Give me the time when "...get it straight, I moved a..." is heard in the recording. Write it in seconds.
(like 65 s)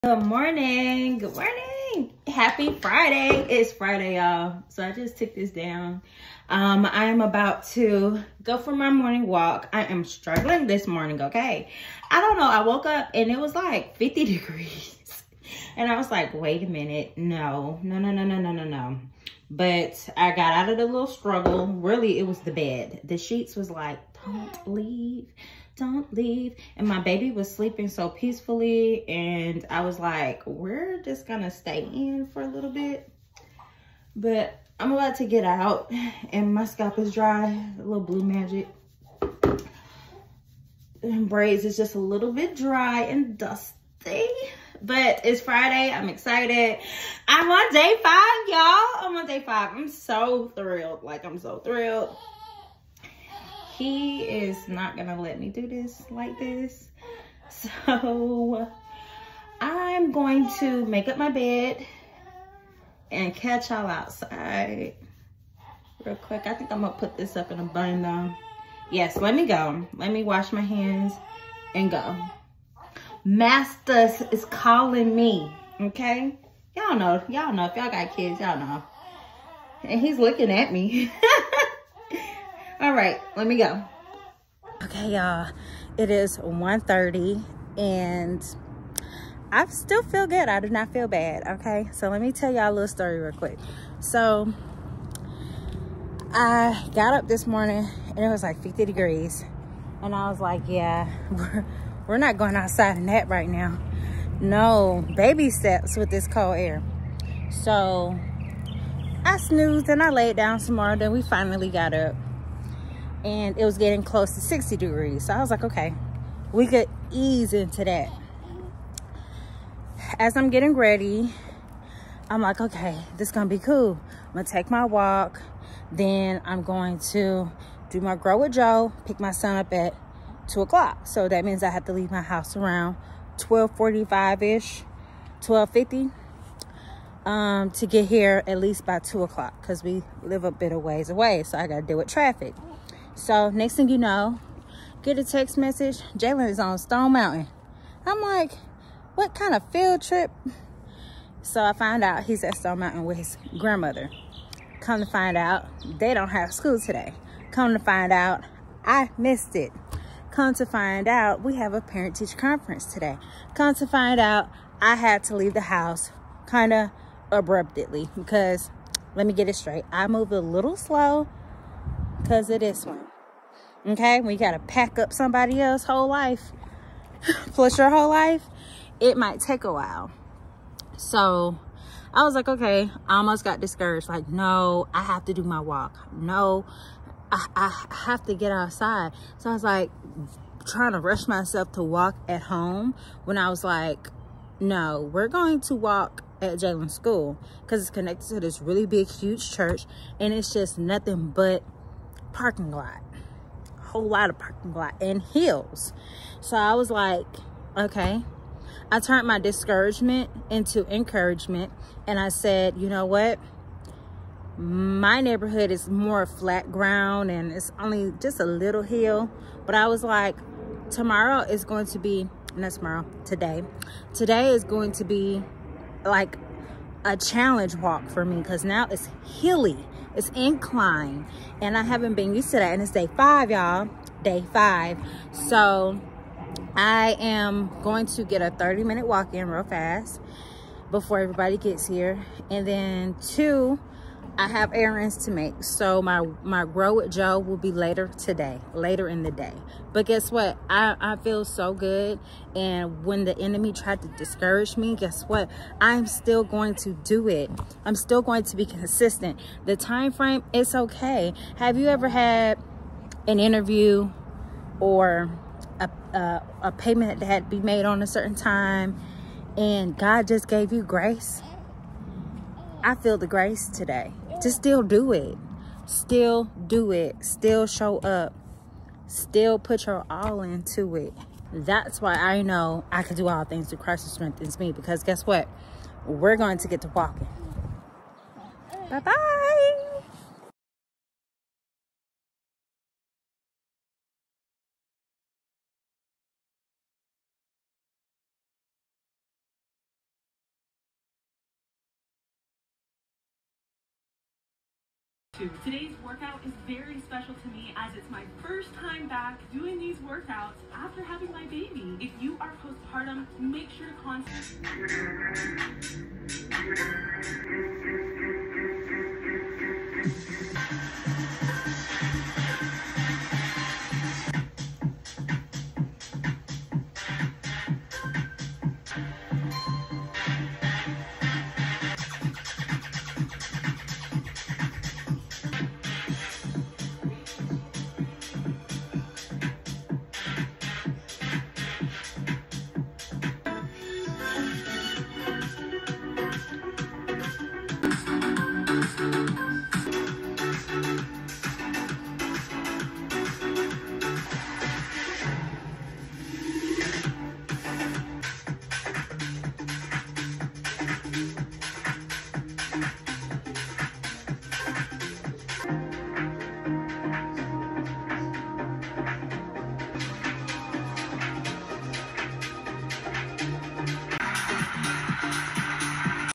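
169 s.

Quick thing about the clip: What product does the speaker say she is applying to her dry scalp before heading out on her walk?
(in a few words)
Blue Magic.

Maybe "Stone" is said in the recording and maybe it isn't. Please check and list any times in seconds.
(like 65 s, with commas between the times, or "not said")
146 s, 152 s.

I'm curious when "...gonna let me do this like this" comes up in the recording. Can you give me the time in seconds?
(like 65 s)
54 s.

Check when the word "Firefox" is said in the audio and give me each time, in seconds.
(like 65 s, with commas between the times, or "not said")
not said.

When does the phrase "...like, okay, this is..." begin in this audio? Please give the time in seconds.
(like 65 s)
122 s.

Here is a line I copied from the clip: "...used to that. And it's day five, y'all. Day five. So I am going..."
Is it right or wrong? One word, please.
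right.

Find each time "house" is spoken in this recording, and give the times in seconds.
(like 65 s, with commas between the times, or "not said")
132 s, 165 s.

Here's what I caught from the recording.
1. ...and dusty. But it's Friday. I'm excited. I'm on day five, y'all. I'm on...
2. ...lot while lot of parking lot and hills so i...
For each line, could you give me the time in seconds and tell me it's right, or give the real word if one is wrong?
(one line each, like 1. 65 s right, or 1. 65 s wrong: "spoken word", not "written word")
1. 43 s right
2. 202 s wrong: "whole", not "while".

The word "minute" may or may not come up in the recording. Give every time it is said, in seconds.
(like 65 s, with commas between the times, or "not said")
16 s, 238 s.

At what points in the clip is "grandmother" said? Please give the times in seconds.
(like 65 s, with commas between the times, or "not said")
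153 s.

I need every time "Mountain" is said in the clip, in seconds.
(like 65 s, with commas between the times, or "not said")
147 s, 152 s.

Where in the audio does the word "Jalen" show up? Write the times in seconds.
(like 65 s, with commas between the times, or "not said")
146 s, 196 s.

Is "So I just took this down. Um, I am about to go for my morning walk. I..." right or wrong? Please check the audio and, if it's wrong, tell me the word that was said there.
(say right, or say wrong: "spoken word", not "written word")
right.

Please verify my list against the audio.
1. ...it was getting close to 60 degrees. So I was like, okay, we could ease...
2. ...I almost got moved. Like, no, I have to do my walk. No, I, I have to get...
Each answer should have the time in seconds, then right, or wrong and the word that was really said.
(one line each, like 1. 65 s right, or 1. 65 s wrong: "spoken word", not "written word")
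1. 113 s right
2. 183 s wrong: "discouraged", not "moved".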